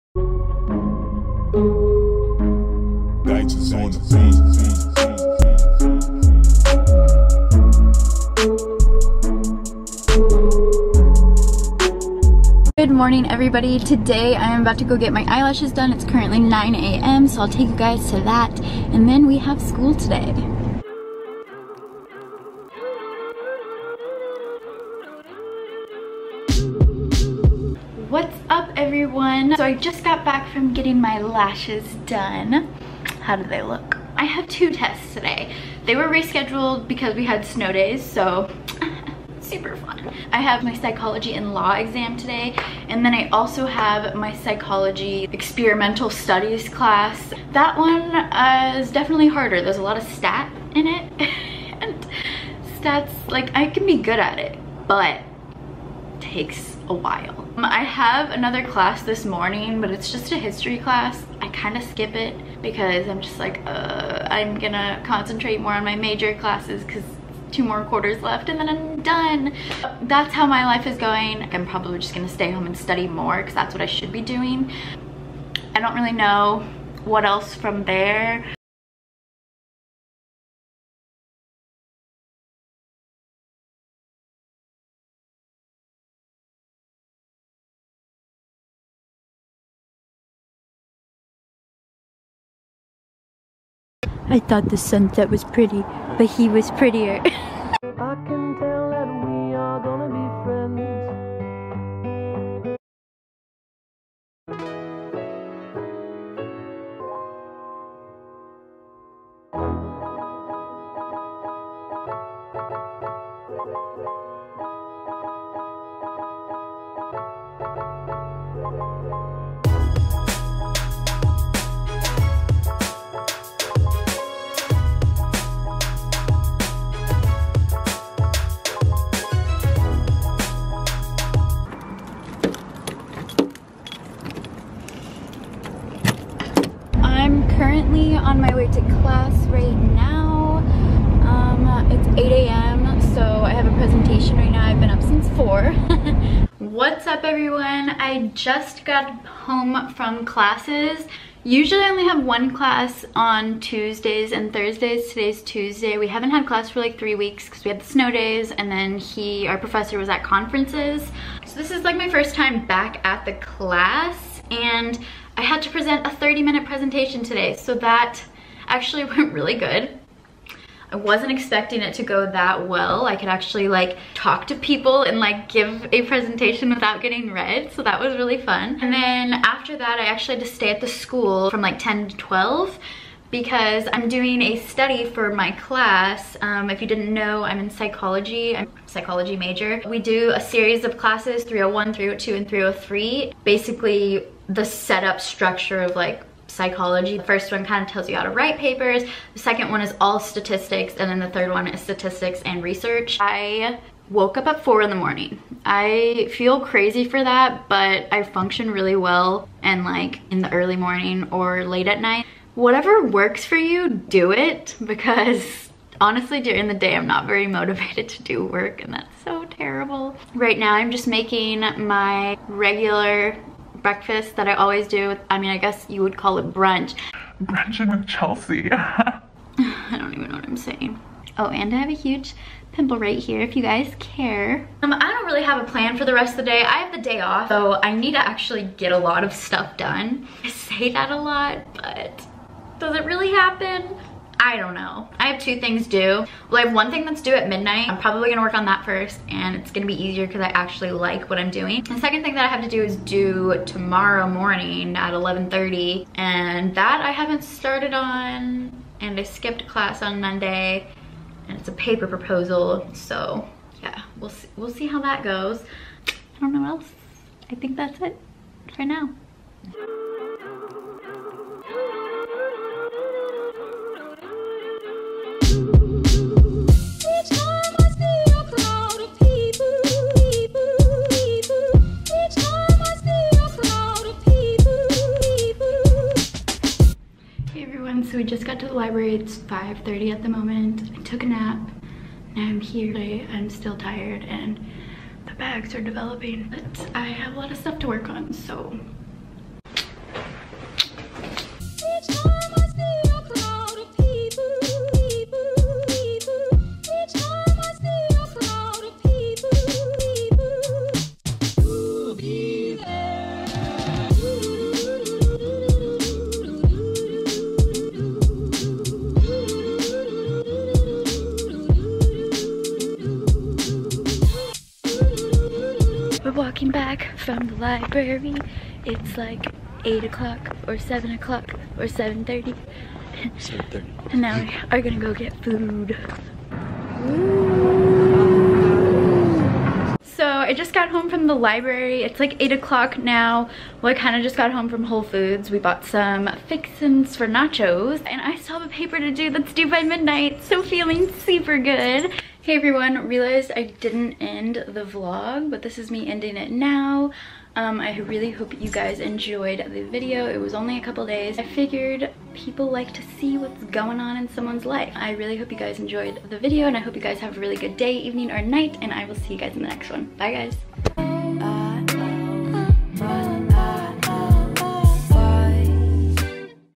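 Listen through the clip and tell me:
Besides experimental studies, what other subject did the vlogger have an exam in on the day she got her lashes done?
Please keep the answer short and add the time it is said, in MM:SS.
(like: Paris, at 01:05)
Psychology and law, at 00:40.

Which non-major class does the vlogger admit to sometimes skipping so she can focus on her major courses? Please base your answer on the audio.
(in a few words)
History.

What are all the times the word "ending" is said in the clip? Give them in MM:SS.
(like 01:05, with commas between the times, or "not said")
05:56.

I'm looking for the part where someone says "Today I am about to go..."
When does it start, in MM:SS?
00:13.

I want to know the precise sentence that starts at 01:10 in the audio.
That's how my life is going.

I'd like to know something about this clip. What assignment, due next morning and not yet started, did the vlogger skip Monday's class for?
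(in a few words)
Paper proposal.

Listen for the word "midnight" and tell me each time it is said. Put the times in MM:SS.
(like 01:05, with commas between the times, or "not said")
04:07, 05:49.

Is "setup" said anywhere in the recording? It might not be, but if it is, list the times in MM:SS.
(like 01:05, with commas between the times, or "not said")
03:14.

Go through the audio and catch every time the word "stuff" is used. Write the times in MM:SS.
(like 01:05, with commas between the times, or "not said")
03:59, 04:57.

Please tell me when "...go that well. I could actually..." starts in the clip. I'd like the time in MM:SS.
02:52.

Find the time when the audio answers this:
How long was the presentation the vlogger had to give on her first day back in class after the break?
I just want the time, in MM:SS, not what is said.
02:46.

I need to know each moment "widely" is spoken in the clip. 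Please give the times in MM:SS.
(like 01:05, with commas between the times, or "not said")
not said.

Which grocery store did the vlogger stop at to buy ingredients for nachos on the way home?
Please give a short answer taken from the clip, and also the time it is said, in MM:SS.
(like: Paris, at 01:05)
Whole Foods, at 05:44.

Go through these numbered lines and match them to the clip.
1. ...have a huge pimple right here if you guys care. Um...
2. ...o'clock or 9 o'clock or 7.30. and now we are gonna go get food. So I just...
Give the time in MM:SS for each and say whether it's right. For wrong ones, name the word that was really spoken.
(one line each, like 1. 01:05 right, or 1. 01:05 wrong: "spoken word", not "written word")
1. 03:51 right
2. 05:30 wrong: "7", not "9".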